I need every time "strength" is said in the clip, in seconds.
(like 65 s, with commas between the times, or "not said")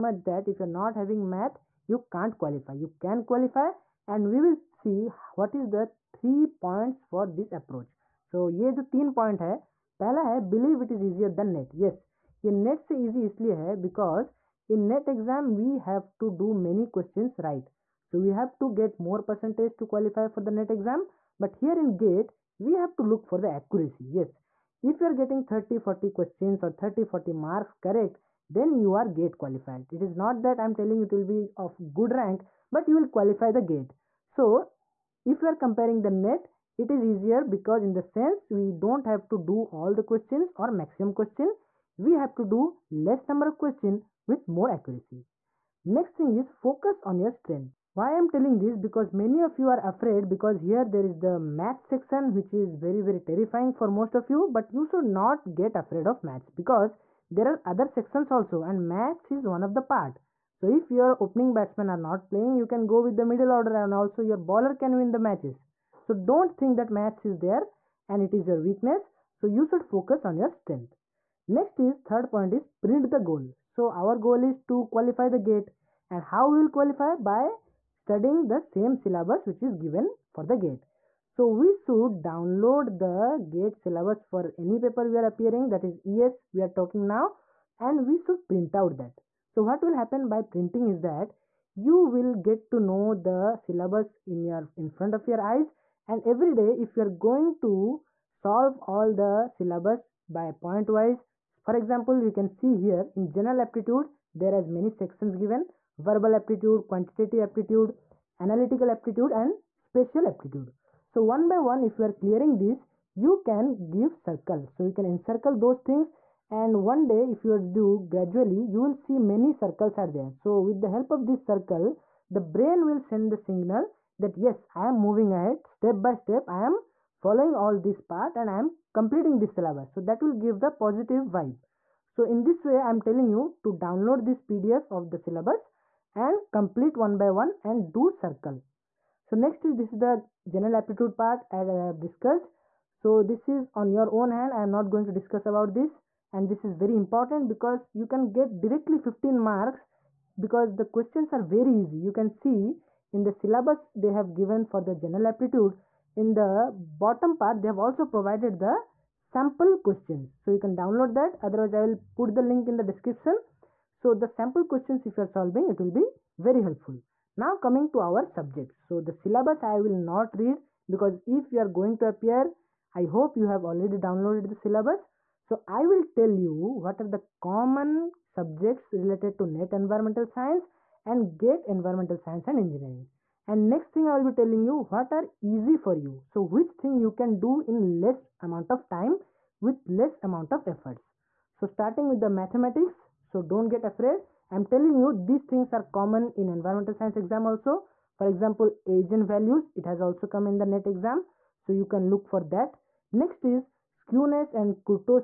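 47 s, 70 s.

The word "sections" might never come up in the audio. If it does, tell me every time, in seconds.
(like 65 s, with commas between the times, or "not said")
51 s, 57 s, 105 s.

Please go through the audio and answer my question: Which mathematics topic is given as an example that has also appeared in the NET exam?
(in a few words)
eigen values.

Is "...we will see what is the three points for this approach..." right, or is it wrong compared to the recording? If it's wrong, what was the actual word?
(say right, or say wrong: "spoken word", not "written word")
right.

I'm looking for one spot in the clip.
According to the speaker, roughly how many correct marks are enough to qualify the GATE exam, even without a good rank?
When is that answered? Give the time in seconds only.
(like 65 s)
26 s.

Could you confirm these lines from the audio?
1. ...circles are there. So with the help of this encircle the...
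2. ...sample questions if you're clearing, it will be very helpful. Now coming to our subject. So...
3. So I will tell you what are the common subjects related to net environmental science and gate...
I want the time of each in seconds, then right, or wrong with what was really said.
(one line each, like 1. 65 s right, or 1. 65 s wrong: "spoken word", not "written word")
1. 119 s wrong: "circle", not "encircle"
2. 164 s wrong: "solving", not "clearing"
3. 175 s right.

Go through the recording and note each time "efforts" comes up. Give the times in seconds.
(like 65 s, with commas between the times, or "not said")
190 s.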